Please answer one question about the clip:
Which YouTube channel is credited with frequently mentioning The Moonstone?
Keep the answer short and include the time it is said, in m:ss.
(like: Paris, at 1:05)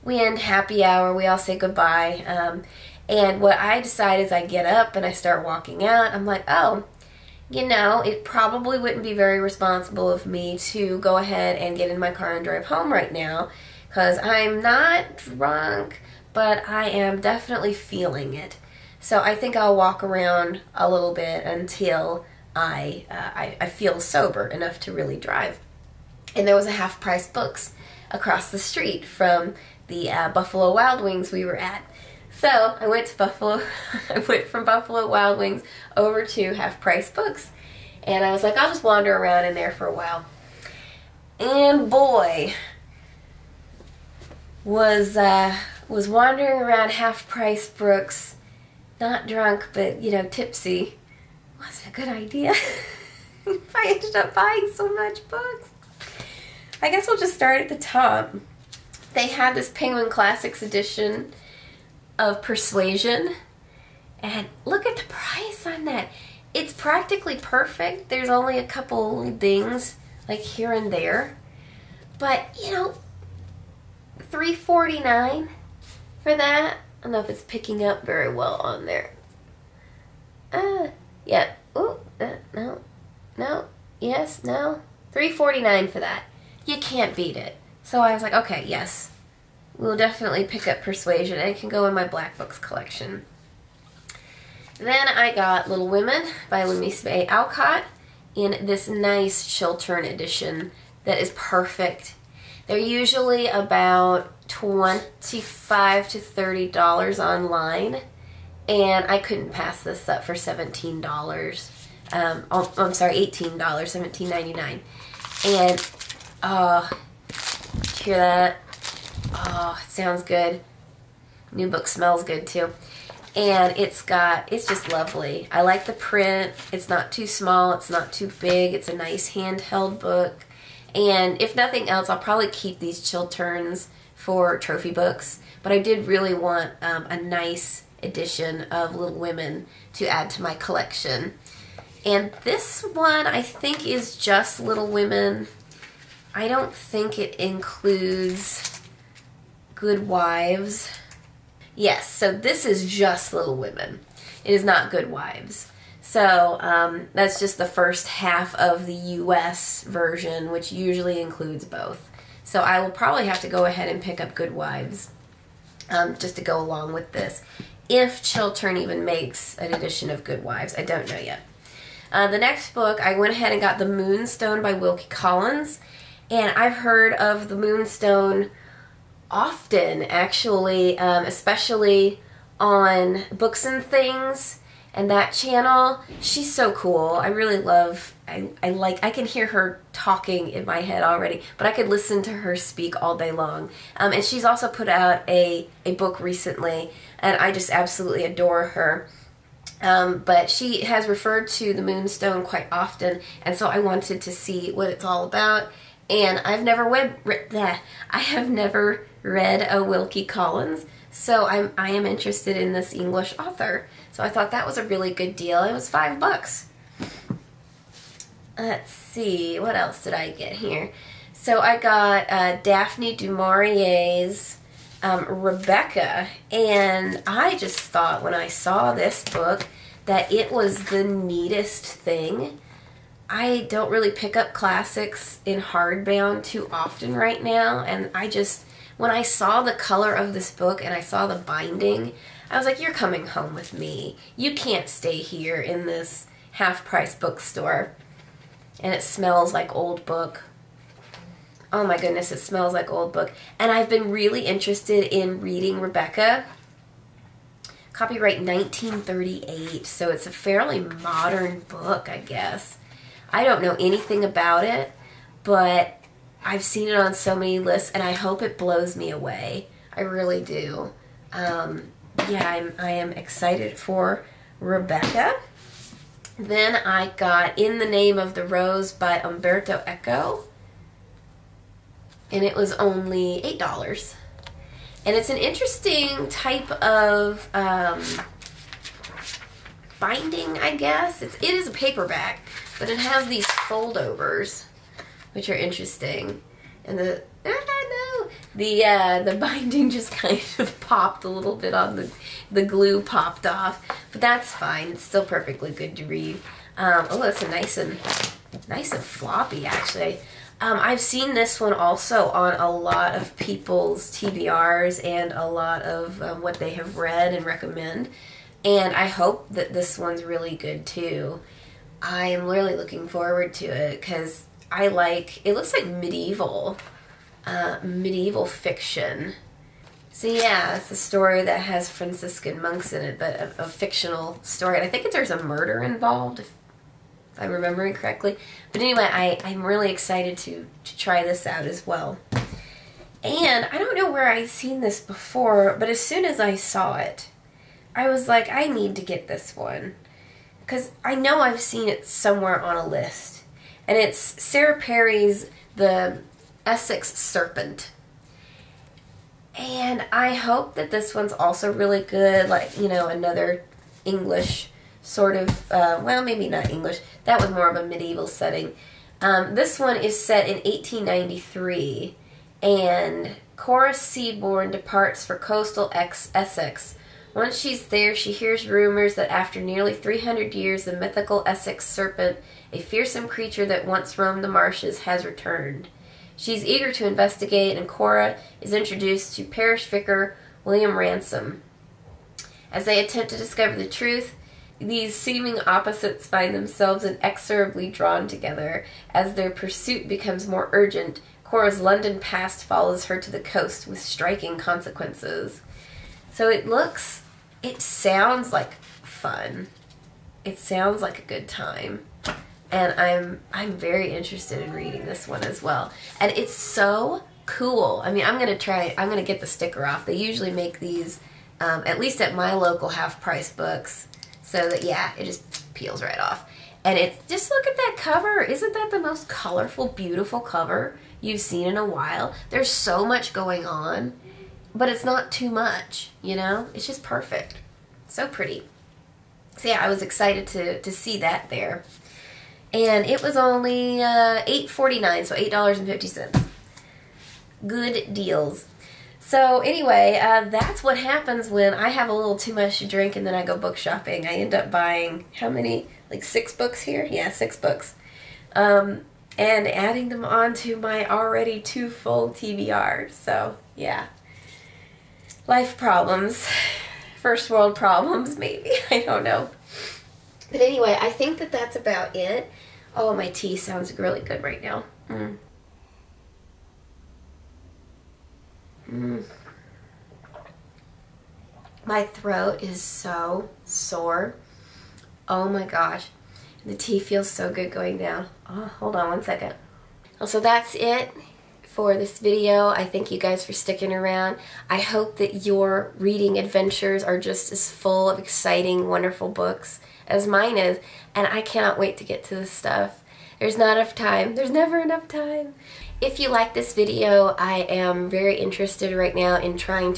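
Books and Things, at 3:03.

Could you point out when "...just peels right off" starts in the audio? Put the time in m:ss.
7:05.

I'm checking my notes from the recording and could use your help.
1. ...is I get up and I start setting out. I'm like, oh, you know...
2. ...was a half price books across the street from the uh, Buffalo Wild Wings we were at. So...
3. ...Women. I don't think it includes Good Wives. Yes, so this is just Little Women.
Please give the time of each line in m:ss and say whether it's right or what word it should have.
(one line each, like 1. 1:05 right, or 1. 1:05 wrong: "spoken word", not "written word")
1. 0:04 wrong: "walking", not "setting"
2. 0:26 right
3. 2:24 right.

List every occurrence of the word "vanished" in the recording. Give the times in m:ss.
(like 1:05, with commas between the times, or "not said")
not said.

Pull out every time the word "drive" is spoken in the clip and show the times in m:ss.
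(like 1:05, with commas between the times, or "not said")
0:12, 0:25.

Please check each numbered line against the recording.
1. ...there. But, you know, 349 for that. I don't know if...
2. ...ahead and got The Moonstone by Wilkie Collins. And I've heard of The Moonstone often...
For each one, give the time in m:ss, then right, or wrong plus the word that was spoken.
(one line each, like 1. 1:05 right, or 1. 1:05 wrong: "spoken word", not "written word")
1. 1:10 right
2. 2:53 right.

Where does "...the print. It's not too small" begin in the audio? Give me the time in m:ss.
2:05.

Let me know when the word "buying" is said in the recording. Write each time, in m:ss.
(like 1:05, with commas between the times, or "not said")
0:54, 7:34.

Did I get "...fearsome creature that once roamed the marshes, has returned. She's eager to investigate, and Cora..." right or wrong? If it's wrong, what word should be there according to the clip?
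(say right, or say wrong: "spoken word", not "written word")
right.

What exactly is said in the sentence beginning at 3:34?
So I thought that was a really good deal.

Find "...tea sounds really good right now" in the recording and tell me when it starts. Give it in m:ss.
7:53.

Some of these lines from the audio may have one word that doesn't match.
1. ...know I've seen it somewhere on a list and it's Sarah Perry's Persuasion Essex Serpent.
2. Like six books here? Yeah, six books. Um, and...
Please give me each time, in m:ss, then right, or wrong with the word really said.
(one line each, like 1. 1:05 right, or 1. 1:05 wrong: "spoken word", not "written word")
1. 5:51 wrong: "The", not "Persuasion"
2. 7:36 right.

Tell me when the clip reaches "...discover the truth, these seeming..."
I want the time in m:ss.
6:33.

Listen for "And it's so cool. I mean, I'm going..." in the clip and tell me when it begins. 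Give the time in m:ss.
6:56.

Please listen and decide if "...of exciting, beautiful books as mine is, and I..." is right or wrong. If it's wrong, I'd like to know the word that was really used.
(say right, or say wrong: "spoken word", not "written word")
wrong: "wonderful", not "beautiful".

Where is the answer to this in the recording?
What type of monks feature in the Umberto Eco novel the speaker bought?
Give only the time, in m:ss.
5:31.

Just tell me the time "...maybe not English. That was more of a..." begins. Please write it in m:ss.
6:06.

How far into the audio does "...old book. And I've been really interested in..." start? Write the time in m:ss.
4:12.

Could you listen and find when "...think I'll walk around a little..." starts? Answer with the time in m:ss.
0:19.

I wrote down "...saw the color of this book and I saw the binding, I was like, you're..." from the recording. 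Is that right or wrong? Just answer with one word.
right.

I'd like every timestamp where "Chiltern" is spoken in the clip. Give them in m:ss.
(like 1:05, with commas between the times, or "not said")
1:39, 2:13, 2:48.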